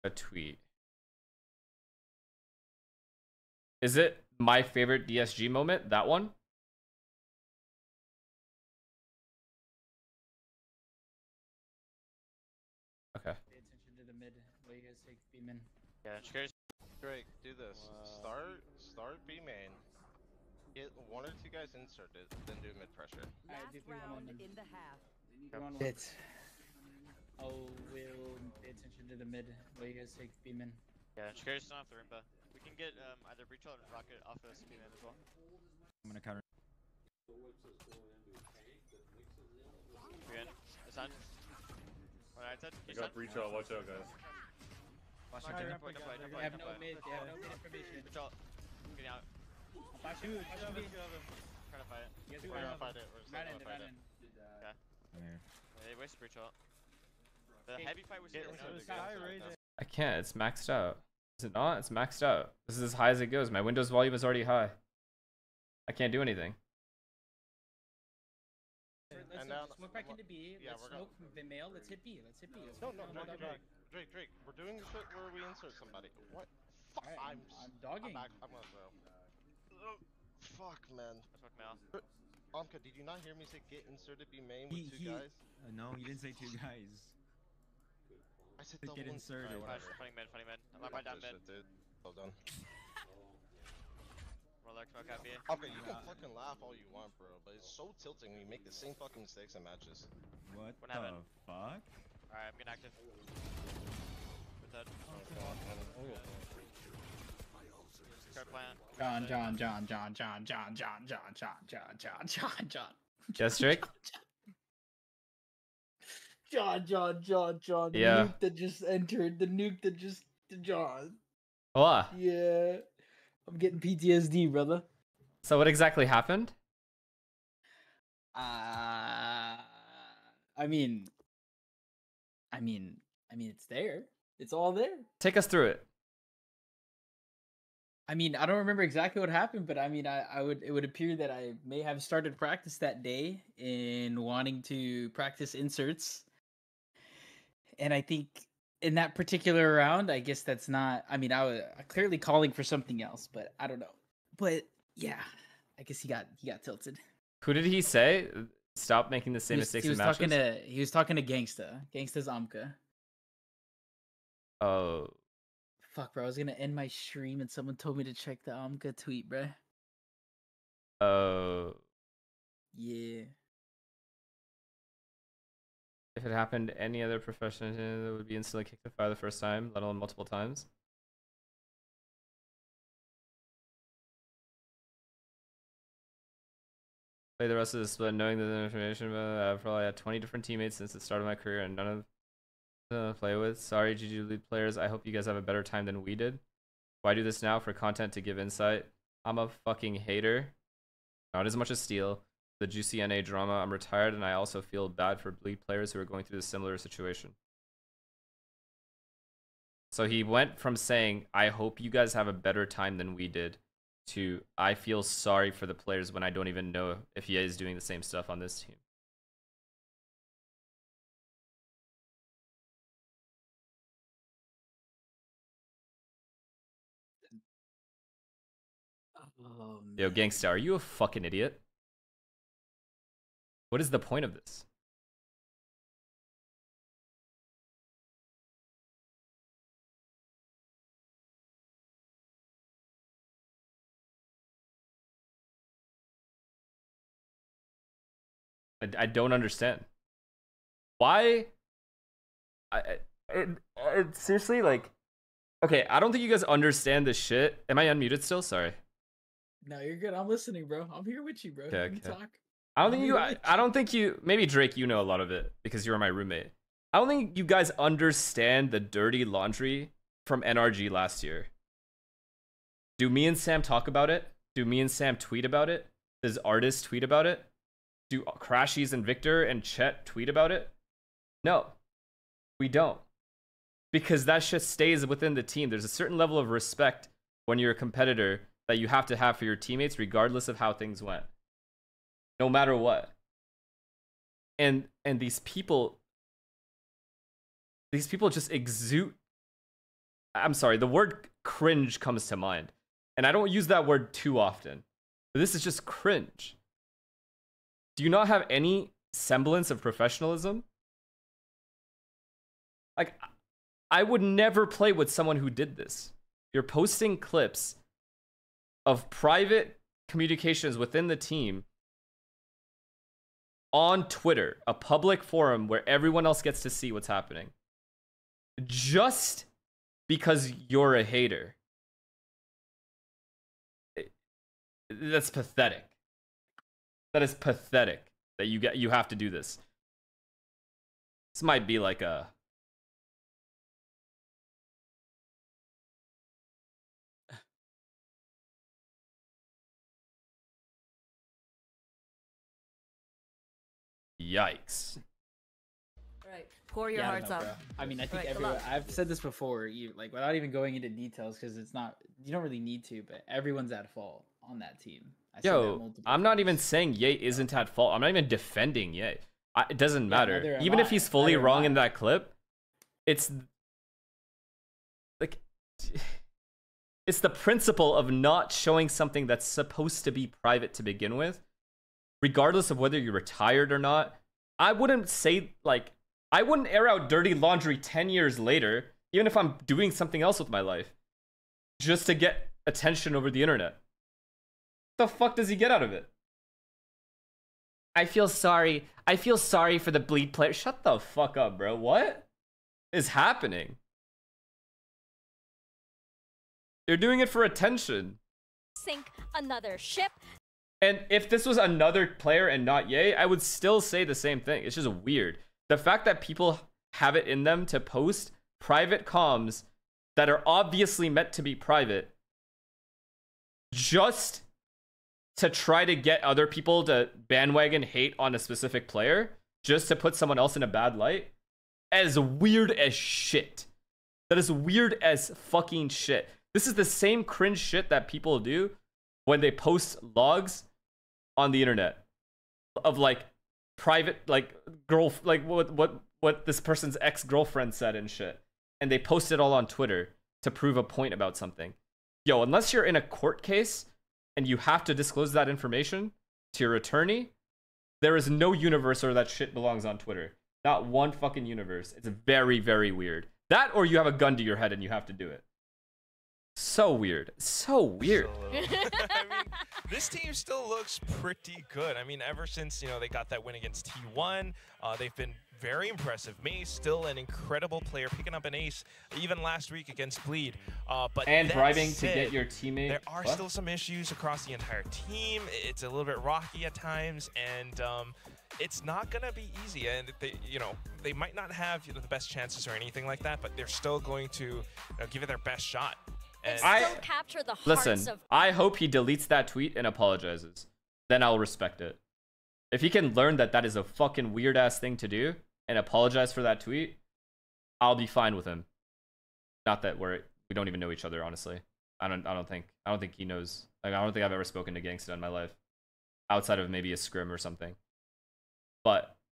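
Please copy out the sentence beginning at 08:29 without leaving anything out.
Not that we're we don't even know each other, honestly.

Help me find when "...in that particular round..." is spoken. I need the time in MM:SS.
02:28.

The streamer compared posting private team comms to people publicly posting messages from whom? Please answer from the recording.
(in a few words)
ex-girlfriend.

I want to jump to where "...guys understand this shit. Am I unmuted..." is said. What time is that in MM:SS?
04:16.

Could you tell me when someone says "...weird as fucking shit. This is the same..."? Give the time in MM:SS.
07:14.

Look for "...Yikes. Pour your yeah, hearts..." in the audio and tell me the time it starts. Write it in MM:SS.
05:54.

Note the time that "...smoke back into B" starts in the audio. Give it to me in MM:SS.
01:09.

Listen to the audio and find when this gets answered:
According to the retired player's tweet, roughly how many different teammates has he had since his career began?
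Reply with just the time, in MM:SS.
03:09.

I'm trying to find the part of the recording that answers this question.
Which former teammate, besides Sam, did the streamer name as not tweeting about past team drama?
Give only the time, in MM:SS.
04:36.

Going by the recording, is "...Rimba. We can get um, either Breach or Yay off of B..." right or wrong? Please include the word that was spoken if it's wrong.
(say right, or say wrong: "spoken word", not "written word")
wrong: "Rocket", not "Yay".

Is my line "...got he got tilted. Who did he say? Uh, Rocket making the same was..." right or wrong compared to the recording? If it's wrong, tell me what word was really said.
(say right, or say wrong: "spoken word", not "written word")
wrong: "Stop", not "Rocket".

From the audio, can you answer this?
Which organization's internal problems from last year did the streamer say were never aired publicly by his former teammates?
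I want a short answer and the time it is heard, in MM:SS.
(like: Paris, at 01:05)
NRG, at 04:30.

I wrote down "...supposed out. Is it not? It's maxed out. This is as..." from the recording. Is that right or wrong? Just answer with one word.
wrong.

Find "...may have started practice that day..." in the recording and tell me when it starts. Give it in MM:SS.
02:21.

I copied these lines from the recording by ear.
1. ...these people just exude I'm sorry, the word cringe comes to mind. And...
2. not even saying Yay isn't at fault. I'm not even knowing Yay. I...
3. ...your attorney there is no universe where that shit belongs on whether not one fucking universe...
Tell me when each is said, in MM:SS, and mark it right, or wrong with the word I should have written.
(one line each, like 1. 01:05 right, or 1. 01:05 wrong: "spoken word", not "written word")
1. 04:57 right
2. 06:06 wrong: "defending", not "knowing"
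3. 07:36 wrong: "twitter", not "whether".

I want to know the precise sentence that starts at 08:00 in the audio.
Uh, but and driving to get your teammate.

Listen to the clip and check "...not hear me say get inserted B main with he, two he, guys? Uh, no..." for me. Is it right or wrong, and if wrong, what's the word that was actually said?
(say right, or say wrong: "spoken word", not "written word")
right.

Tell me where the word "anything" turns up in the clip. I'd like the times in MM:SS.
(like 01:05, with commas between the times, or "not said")
01:06, 08:12.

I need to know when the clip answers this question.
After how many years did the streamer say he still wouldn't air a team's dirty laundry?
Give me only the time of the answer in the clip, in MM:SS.
06:27.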